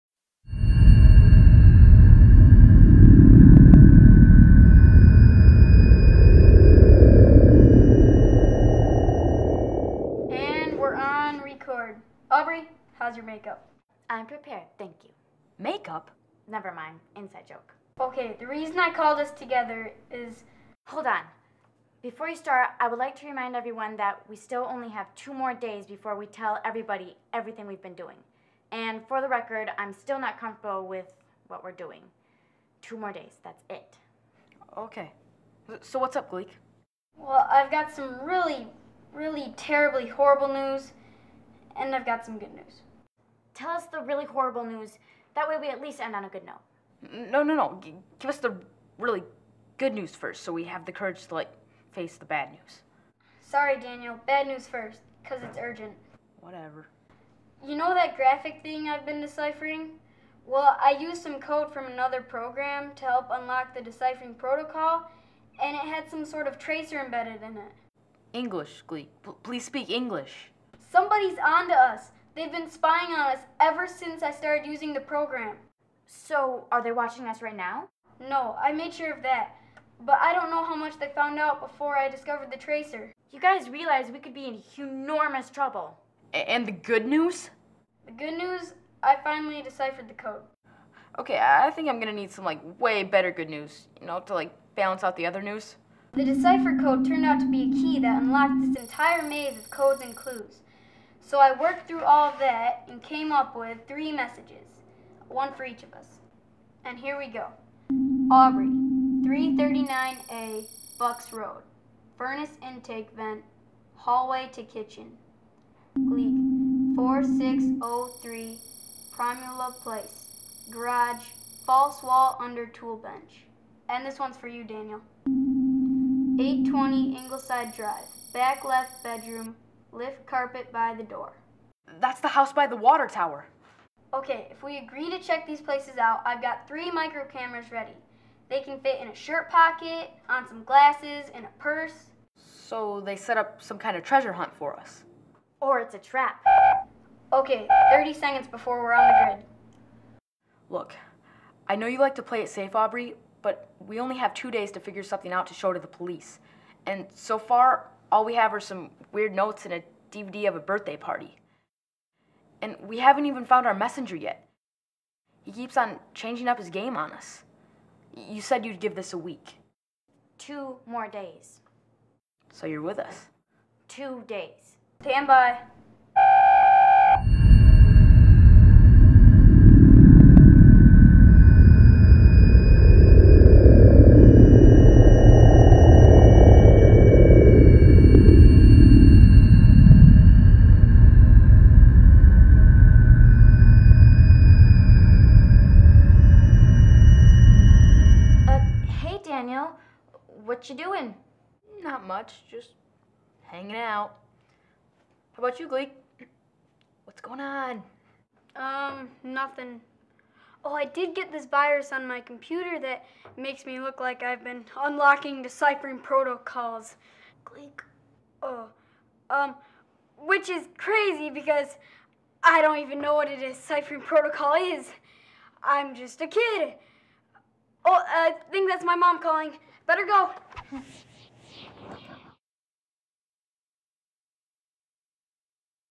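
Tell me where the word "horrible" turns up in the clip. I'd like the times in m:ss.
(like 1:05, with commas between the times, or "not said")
0:40, 0:44.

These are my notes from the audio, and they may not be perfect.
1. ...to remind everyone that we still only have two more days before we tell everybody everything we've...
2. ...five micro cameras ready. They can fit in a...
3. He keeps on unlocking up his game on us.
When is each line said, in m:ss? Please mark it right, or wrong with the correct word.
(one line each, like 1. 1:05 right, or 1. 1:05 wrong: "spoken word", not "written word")
1. 0:23 right
2. 2:16 wrong: "three", not "five"
3. 2:45 wrong: "changing", not "unlocking".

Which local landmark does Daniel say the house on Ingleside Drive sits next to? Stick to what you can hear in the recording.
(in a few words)
the water tower.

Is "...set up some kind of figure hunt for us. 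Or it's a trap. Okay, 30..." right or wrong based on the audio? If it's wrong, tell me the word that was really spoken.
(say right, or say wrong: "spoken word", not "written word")
wrong: "treasure", not "figure".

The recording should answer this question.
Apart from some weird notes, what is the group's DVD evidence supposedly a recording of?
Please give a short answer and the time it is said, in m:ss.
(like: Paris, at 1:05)
a birthday party, at 2:40.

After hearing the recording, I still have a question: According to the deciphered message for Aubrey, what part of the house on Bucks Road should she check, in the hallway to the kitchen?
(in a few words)
furnace intake vent.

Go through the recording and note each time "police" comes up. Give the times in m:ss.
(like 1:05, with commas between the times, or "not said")
2:35.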